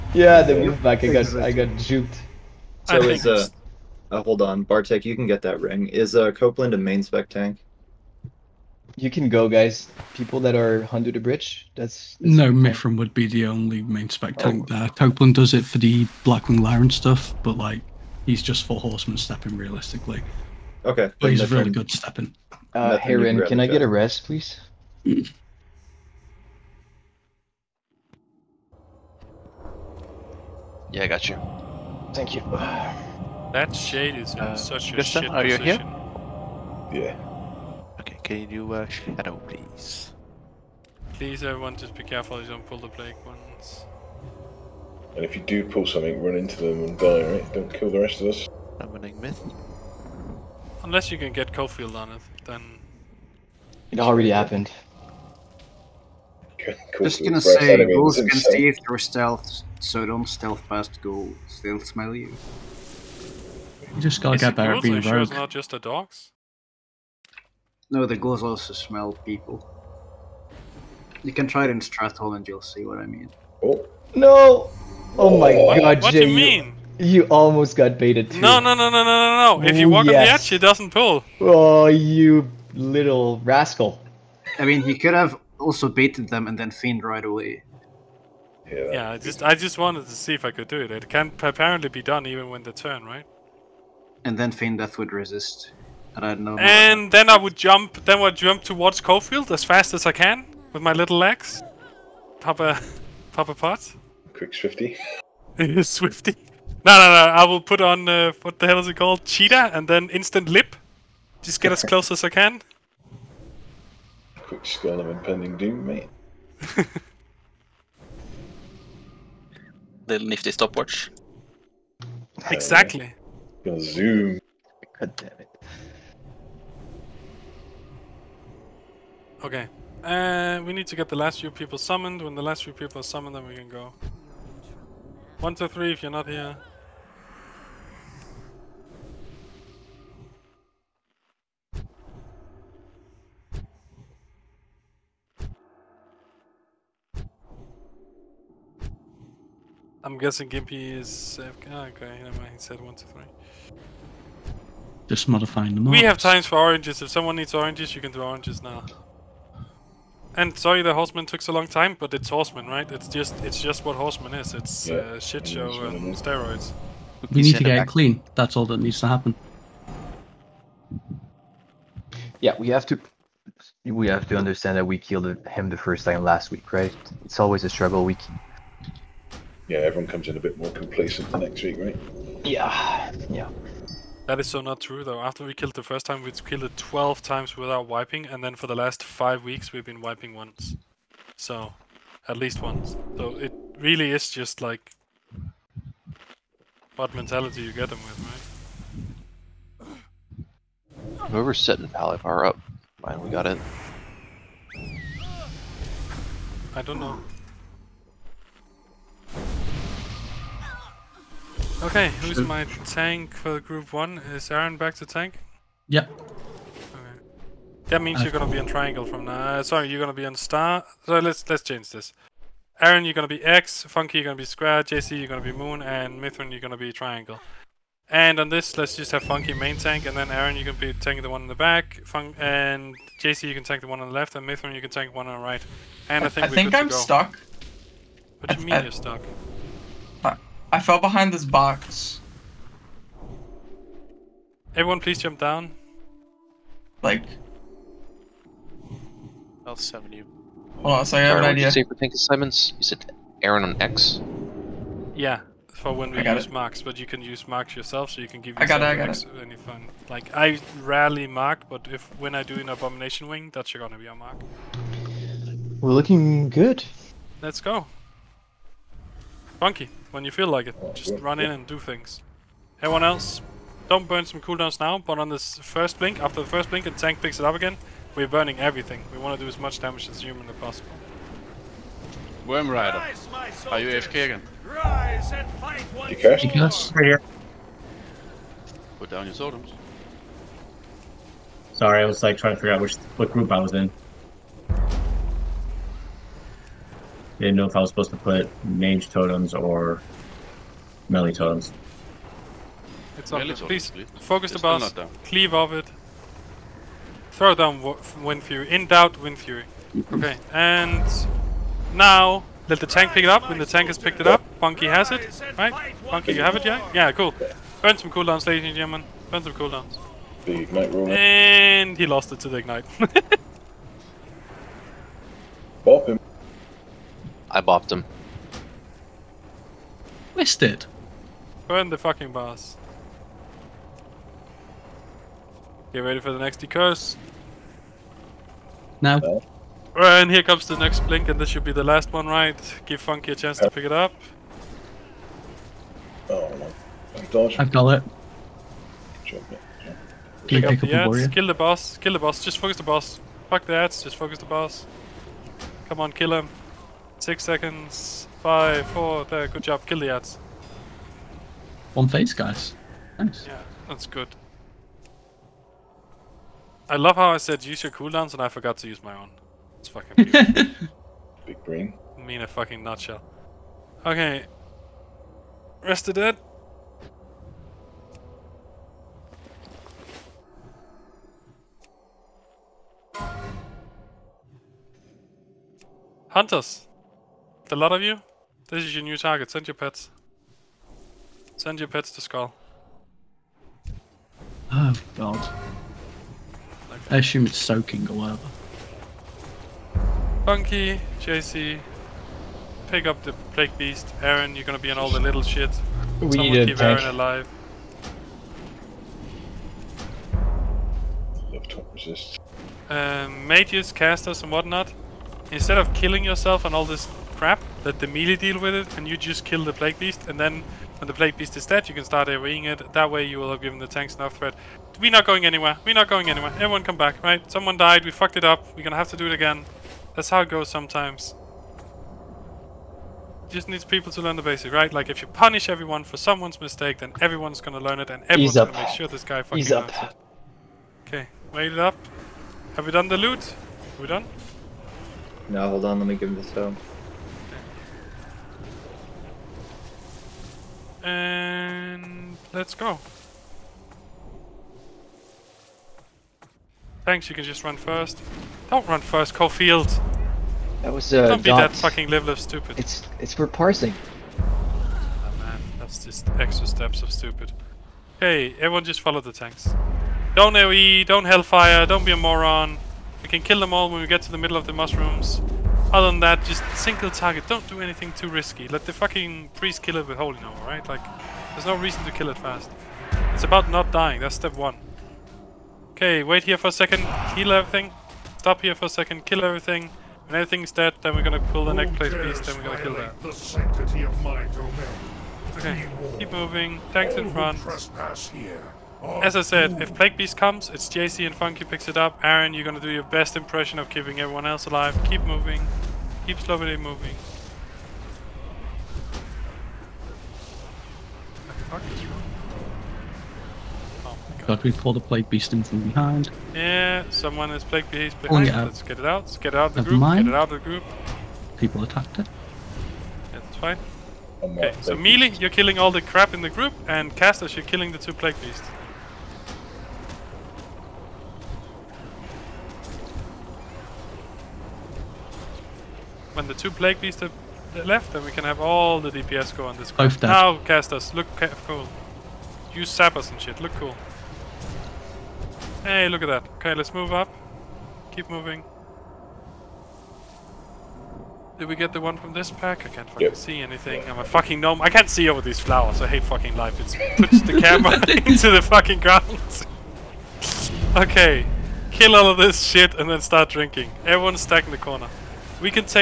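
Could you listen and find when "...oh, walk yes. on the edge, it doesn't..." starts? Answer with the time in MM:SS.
01:19.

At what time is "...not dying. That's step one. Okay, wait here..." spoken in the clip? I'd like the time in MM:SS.
08:03.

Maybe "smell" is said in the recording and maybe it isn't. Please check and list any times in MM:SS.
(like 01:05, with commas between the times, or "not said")
01:01, 01:08.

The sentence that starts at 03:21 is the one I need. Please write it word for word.
Whoever's setting Palivar up, mine we got it.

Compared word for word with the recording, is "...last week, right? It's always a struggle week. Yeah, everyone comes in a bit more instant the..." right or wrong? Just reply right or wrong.
wrong.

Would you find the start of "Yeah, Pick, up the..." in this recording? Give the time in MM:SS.
05:49.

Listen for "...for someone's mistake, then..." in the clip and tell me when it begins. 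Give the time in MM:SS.
07:16.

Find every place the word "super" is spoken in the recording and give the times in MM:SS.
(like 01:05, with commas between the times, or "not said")
not said.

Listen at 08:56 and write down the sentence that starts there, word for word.
When the two Plague Beasts are left, then we can have all the DPS go on this card.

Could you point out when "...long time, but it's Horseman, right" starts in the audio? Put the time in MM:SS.
02:41.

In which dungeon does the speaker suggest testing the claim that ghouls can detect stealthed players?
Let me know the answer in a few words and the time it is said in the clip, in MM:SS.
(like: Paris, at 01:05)
Stratholme, at 01:11.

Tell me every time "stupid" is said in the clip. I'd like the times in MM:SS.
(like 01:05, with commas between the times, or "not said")
07:42, 07:47.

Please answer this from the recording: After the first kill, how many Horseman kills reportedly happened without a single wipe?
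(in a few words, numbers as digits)
12.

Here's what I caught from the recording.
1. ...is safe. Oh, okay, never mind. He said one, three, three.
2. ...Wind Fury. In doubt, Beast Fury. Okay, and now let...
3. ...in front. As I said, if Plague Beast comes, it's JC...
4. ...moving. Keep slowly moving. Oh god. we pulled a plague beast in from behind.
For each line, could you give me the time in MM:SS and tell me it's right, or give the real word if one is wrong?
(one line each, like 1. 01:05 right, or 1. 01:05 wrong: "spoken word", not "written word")
1. 02:30 wrong: "two", not "three"
2. 05:08 wrong: "Wind", not "Beast"
3. 08:17 right
4. 08:25 right.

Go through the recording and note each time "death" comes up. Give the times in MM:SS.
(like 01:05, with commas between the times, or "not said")
01:34.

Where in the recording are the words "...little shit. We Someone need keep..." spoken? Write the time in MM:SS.
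06:45.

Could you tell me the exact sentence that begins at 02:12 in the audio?
When the last few people are summoned, then we can go.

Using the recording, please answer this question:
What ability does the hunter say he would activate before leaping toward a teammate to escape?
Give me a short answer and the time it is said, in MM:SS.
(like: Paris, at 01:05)
Cheetah, at 01:49.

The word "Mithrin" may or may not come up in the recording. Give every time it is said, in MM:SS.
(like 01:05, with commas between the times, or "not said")
00:12, 03:46, 03:54.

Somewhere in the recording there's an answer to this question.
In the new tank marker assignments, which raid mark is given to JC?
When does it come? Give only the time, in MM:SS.
03:44.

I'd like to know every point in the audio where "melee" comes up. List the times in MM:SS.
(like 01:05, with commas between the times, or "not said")
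05:01, 06:58, 08:44.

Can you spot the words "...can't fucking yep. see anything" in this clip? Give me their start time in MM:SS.
09:12.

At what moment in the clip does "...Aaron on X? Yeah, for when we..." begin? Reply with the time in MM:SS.
04:13.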